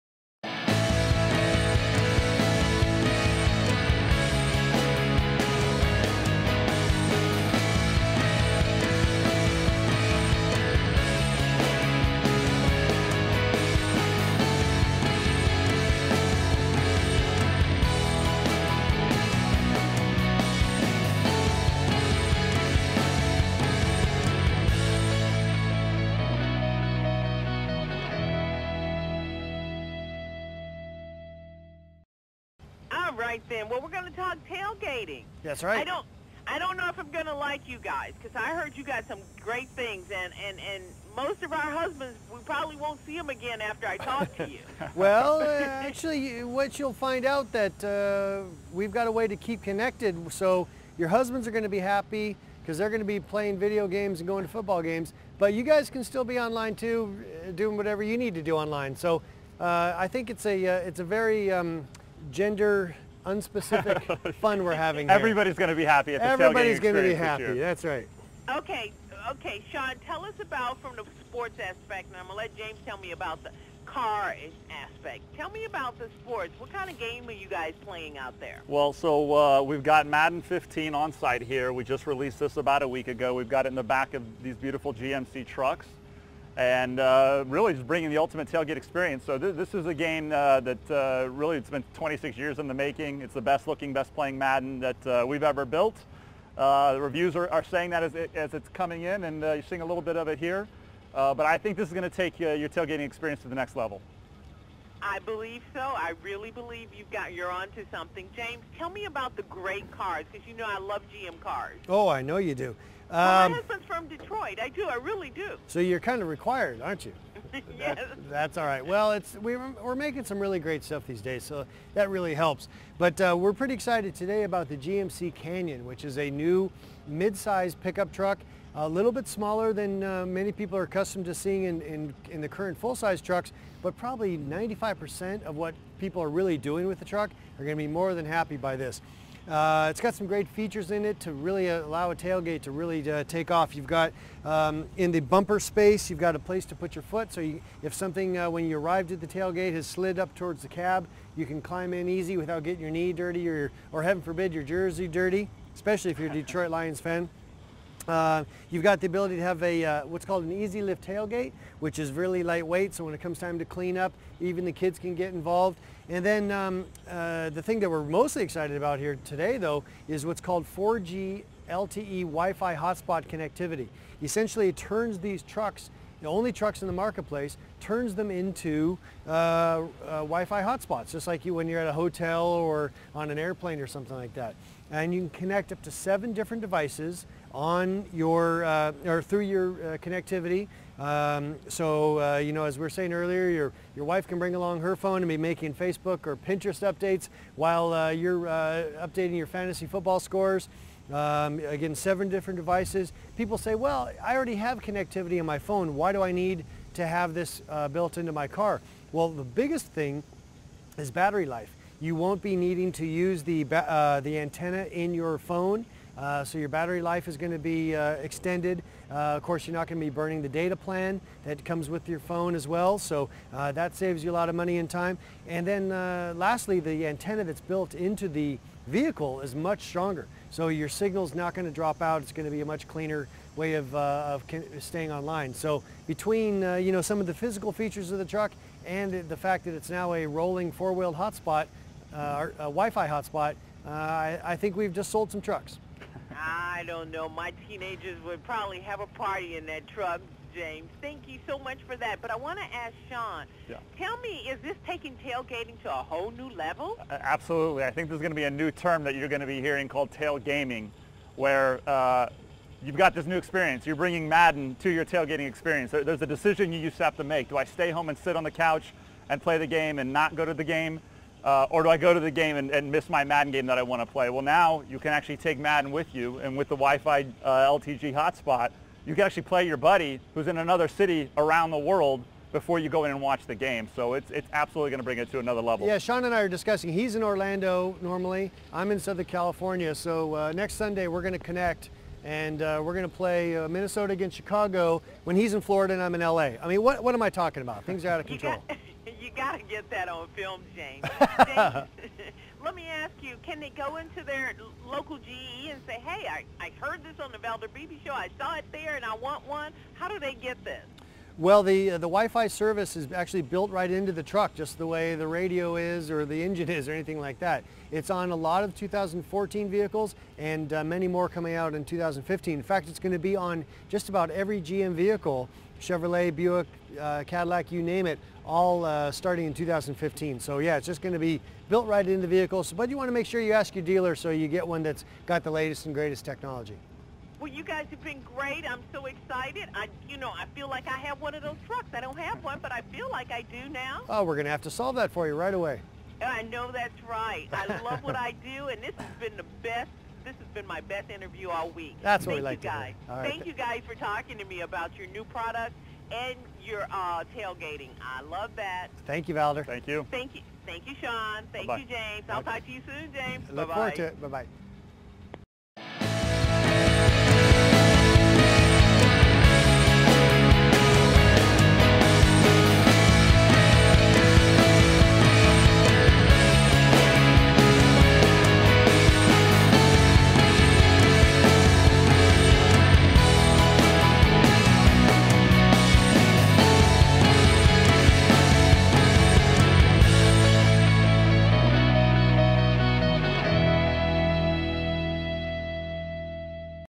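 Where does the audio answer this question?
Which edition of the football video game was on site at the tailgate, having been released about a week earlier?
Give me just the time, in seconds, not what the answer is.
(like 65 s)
80 s.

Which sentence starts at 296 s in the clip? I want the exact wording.
I mean, what, what am I talking about?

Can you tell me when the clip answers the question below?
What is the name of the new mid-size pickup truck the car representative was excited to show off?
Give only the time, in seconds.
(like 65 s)
124 s.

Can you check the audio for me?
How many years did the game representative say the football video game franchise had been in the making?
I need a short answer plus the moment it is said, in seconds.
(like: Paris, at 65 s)
26 years, at 91 s.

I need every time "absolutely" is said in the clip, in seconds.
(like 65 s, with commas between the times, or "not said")
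257 s, 284 s.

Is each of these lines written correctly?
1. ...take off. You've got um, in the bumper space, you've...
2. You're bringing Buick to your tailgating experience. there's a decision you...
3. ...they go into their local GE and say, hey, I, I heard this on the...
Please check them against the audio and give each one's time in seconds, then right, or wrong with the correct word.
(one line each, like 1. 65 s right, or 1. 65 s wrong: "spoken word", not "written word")
1. 143 s right
2. 263 s wrong: "Madden", not "Buick"
3. 303 s right.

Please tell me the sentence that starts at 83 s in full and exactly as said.
We've got it in the back of these beautiful GMC trucks and uh, really just bringing the ultimate tailgate experience.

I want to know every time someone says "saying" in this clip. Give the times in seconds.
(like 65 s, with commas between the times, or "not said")
97 s, 192 s.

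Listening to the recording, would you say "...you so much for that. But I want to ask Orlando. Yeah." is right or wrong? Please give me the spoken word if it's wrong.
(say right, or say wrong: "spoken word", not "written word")
wrong: "Sean", not "Orlando".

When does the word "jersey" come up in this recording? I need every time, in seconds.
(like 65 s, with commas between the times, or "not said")
154 s.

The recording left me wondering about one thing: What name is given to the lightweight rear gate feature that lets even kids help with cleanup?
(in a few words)
easy lift tailgate.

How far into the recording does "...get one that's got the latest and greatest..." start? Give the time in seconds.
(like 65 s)
334 s.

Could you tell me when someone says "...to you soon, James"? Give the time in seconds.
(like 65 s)
362 s.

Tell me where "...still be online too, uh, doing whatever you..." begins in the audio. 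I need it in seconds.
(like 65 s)
56 s.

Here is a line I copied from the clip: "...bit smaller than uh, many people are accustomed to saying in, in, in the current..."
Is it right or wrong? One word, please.
wrong.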